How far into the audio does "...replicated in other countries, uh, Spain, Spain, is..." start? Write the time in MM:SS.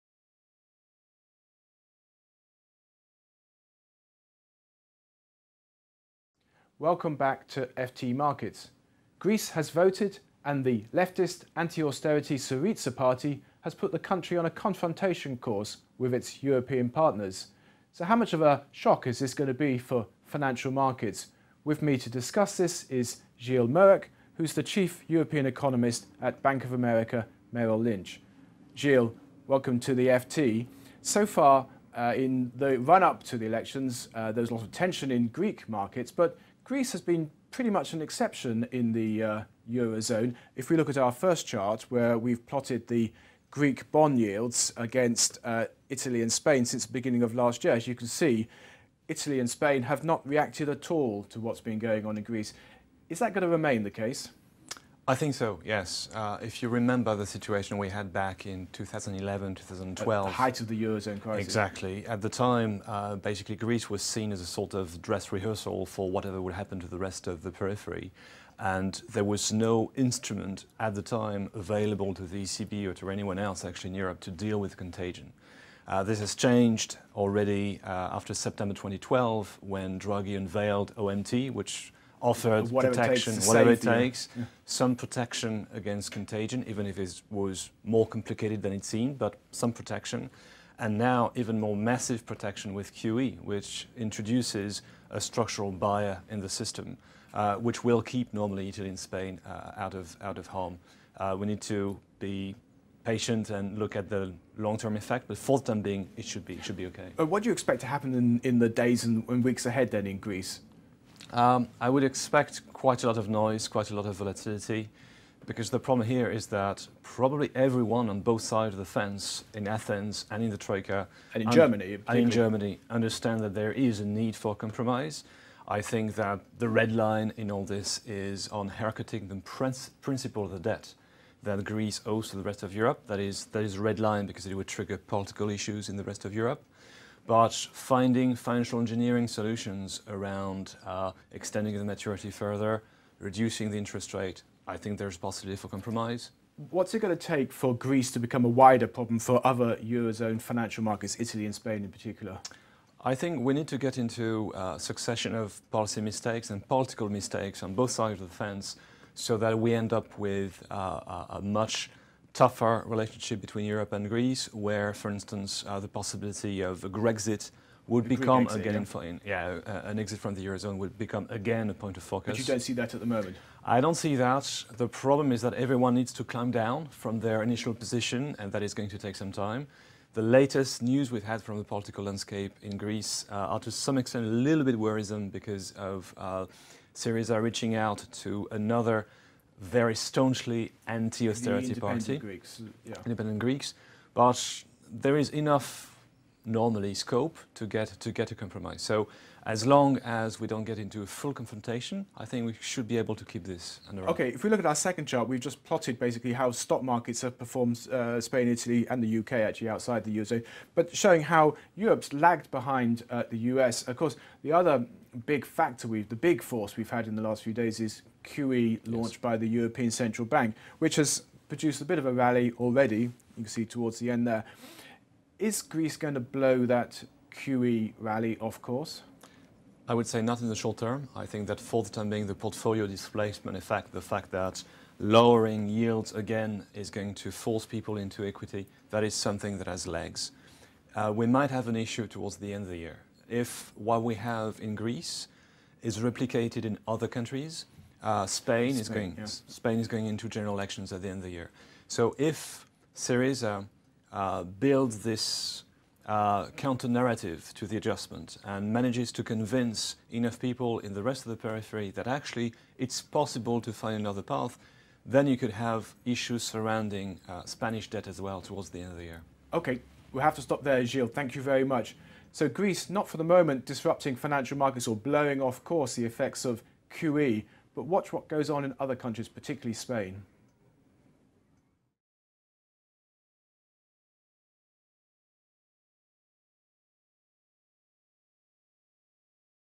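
04:05.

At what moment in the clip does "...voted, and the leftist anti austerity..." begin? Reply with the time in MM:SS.
00:09.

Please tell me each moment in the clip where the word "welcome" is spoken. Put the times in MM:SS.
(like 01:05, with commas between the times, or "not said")
00:06, 00:29.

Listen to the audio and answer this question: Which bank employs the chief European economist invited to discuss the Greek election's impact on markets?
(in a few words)
Bank of America Merrill Lynch.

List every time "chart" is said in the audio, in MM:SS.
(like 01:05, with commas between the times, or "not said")
00:41, 03:25.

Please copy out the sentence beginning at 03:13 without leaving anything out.
independent Greeks, but there is enough normally scope to get, to get a compromise.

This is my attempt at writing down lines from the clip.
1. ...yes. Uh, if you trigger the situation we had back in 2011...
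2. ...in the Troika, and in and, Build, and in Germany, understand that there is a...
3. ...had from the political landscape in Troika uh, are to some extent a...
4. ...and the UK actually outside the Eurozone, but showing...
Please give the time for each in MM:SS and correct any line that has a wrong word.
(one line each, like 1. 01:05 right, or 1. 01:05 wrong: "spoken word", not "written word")
1. 00:55 wrong: "remember", not "trigger"
2. 02:00 wrong: "Germany", not "Build"
3. 03:01 wrong: "Greece", not "Troika"
4. 03:28 right.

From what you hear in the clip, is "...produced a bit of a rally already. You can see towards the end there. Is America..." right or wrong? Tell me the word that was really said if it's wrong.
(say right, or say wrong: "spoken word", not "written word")
wrong: "Greece", not "America".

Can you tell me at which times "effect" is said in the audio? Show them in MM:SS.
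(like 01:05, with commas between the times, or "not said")
01:44, 03:53, 04:36.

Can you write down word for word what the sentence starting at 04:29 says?
Okay, we'll have to stop there, Gilles.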